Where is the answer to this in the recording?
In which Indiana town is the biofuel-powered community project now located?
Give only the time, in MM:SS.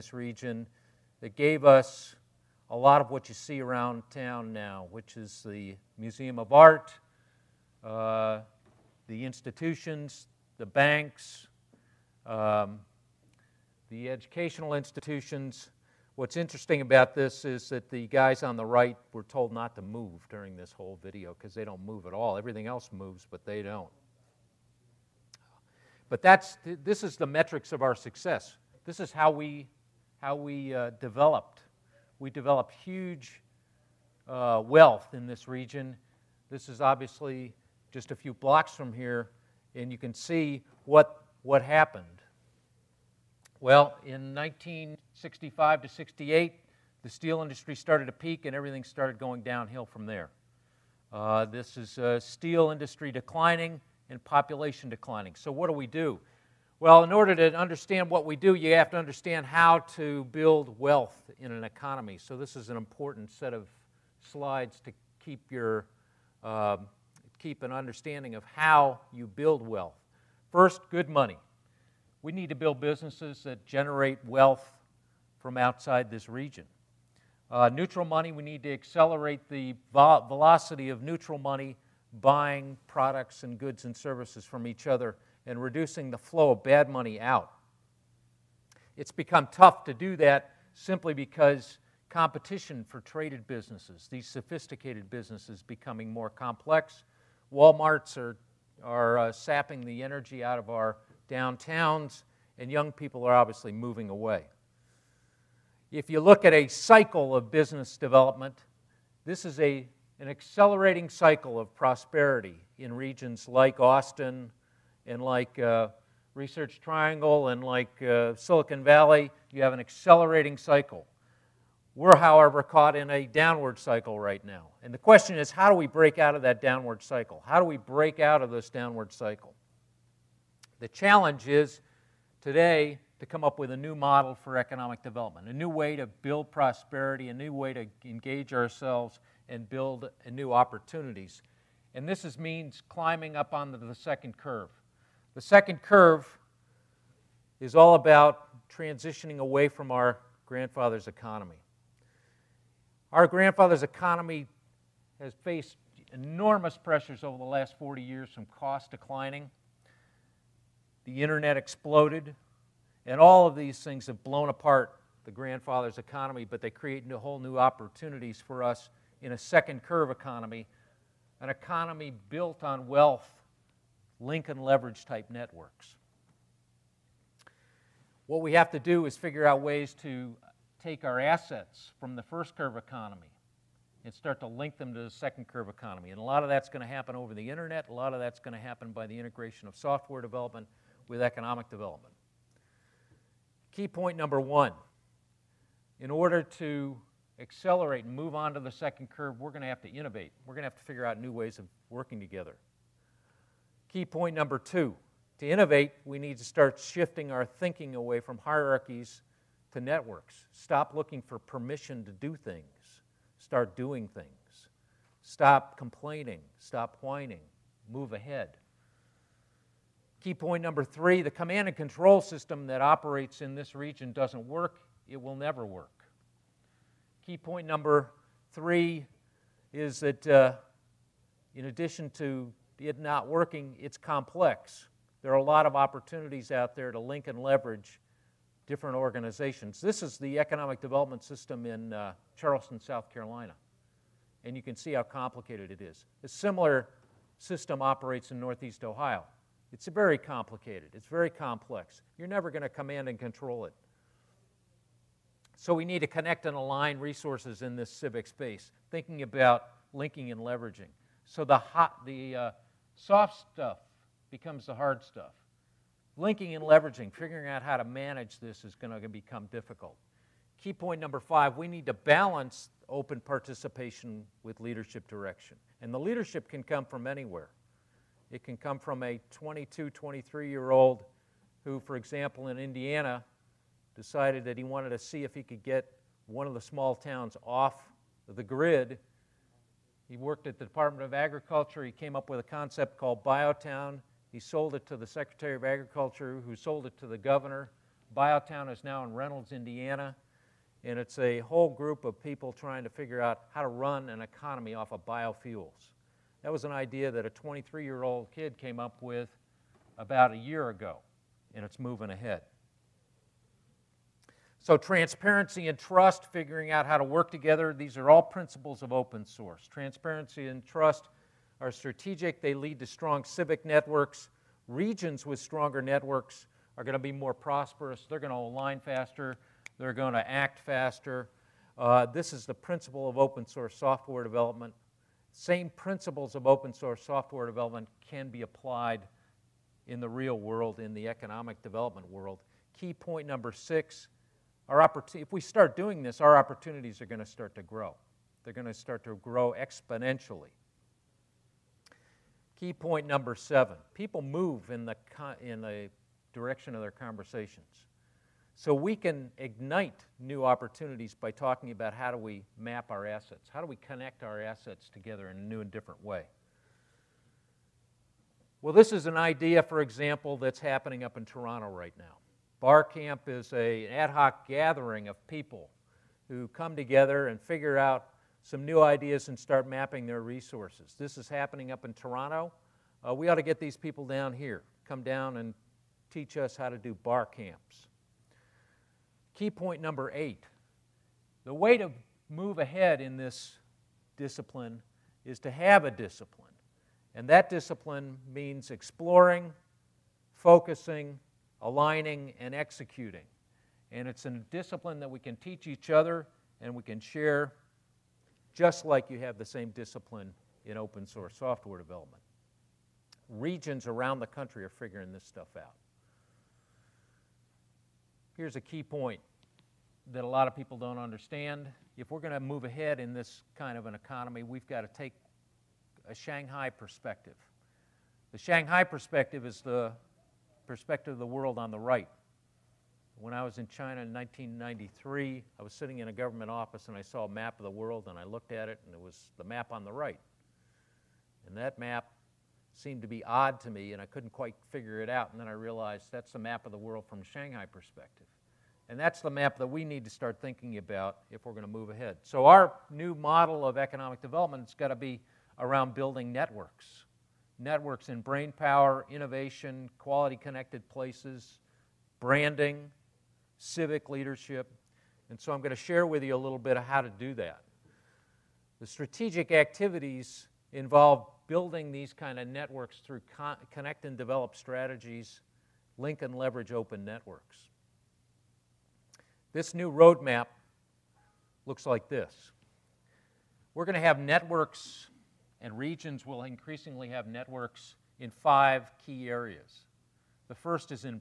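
04:59.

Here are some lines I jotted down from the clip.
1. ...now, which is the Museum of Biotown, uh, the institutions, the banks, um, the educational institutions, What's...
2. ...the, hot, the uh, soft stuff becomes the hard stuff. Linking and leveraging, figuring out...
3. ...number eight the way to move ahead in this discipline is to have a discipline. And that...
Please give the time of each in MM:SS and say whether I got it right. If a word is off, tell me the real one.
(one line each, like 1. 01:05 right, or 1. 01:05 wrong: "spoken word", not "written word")
1. 00:04 wrong: "Art", not "Biotown"
2. 04:21 right
3. 06:29 right.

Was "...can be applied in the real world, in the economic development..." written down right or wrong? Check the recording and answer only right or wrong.
right.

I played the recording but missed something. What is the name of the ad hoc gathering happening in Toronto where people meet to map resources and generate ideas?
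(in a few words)
Bar Camp.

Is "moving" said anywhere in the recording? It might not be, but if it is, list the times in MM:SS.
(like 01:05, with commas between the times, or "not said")
01:43, 05:11.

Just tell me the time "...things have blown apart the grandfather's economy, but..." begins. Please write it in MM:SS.
02:43.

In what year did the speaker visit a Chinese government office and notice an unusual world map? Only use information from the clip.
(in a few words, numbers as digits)
1993.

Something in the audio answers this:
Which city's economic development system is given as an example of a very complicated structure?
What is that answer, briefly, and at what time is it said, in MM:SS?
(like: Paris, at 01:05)
Charleston, South Carolina, at 04:02.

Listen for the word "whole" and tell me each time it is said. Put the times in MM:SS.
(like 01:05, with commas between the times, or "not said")
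00:20, 02:47, 05:01.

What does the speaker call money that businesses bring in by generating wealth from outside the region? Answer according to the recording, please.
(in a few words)
Good money.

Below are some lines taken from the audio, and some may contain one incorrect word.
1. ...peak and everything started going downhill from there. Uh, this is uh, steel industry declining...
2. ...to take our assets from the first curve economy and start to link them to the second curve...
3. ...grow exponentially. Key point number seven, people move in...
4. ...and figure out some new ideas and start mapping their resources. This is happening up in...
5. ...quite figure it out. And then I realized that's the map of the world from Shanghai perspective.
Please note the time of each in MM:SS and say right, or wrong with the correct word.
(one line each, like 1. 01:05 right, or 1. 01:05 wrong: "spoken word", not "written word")
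1. 00:48 right
2. 03:00 right
3. 05:49 right
4. 06:17 right
5. 07:24 right.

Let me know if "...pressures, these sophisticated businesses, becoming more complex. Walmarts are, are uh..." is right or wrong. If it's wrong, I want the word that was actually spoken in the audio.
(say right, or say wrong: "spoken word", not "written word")
wrong: "businesses", not "pressures".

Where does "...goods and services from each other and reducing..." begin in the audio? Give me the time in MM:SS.
01:23.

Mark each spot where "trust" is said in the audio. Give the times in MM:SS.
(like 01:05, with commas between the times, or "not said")
05:15, 05:20.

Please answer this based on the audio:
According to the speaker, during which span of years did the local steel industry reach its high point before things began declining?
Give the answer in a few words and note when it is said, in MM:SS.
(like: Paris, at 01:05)
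1965 to 68, at 00:44.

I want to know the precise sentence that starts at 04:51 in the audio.
He came up with a concept called Biotown.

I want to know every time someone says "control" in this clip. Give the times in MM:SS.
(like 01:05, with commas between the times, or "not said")
03:41, 04:13.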